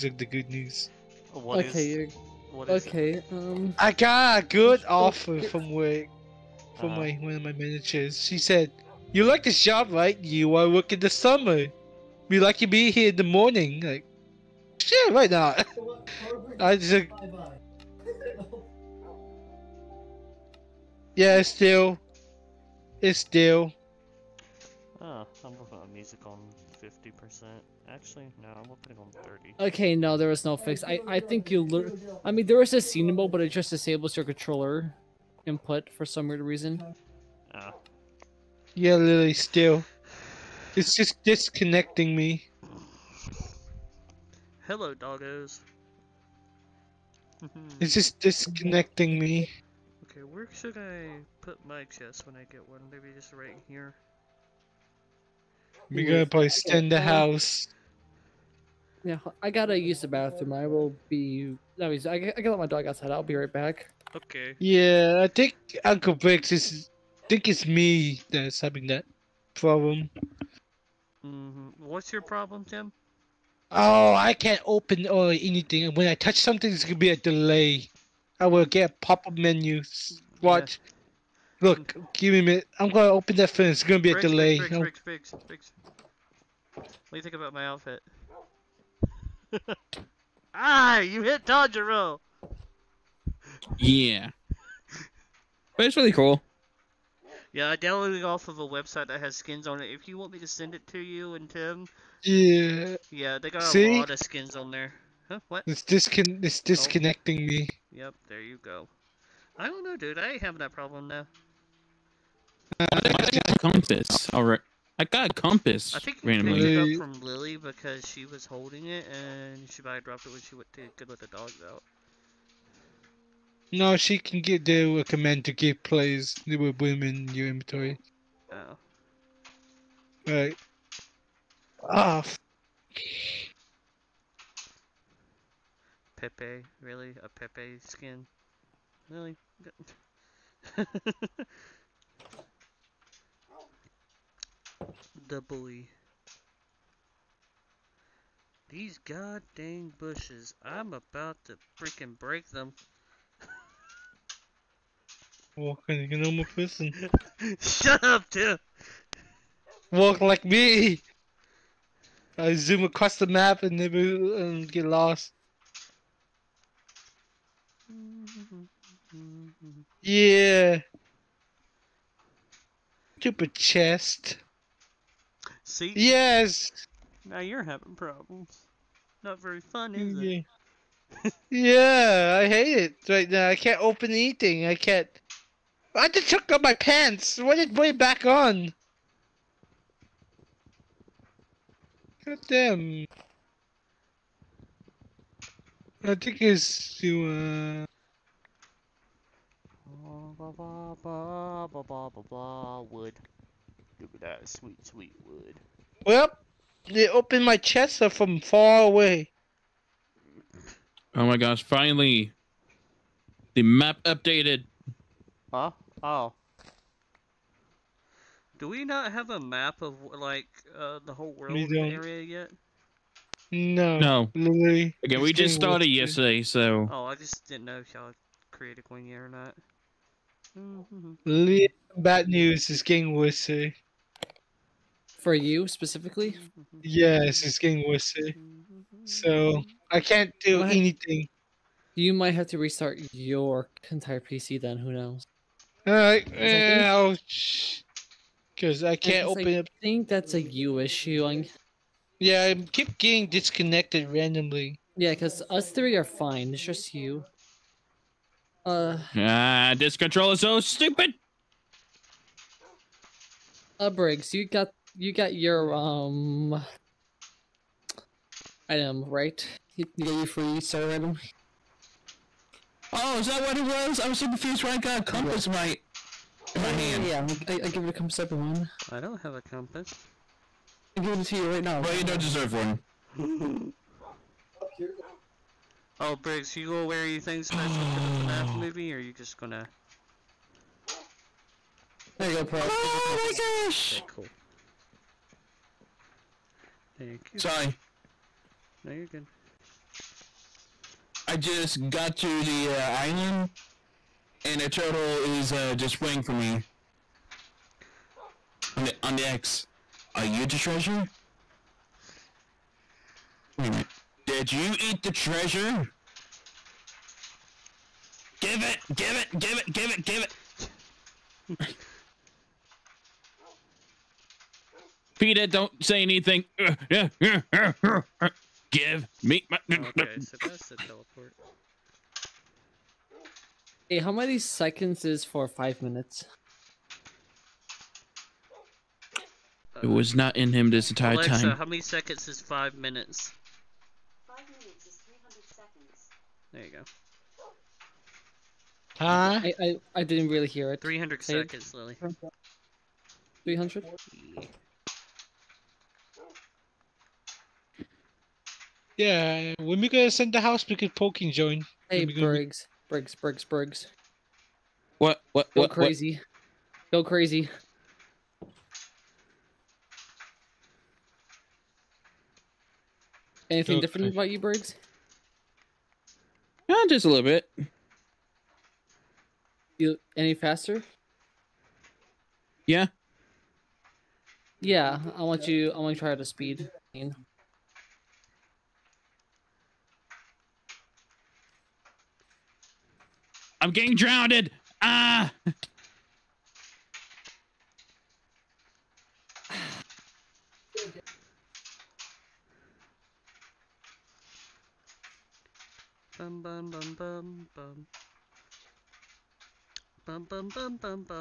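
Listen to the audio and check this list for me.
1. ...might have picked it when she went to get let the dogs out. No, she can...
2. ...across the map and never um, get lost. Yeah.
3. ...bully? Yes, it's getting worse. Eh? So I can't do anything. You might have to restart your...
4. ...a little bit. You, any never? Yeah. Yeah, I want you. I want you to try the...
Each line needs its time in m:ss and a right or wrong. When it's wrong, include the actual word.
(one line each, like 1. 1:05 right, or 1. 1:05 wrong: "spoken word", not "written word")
1. 1:59 wrong: "dropped", not "picked"
2. 2:42 right
3. 3:55 wrong: "specifically", not "bully"
4. 6:17 wrong: "faster", not "never".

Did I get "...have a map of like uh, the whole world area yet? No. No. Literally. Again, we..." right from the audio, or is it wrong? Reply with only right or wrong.
right.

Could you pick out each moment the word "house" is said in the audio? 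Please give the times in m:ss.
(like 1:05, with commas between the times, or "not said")
0:57, 6:00.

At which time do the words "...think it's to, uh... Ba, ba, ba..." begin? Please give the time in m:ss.
3:16.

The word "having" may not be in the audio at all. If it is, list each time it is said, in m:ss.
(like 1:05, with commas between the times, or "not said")
1:08, 1:50, 2:57.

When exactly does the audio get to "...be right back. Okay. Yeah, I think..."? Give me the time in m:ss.
1:03.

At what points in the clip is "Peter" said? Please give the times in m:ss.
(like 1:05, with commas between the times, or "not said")
5:25.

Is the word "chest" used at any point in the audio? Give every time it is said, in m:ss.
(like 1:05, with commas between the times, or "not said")
0:51, 2:53, 3:27.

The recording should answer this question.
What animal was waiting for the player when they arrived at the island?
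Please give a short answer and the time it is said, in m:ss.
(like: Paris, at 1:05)
A turtle, at 5:04.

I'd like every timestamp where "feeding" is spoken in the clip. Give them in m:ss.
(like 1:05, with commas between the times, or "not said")
not said.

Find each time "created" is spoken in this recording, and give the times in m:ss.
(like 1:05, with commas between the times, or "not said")
3:48.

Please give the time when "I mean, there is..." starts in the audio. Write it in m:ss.
0:32.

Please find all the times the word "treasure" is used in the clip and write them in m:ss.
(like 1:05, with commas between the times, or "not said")
5:10, 5:15.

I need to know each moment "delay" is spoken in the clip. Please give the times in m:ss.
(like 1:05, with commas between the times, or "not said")
1:17, 1:24.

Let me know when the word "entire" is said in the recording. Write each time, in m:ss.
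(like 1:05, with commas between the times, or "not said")
4:03, 5:40.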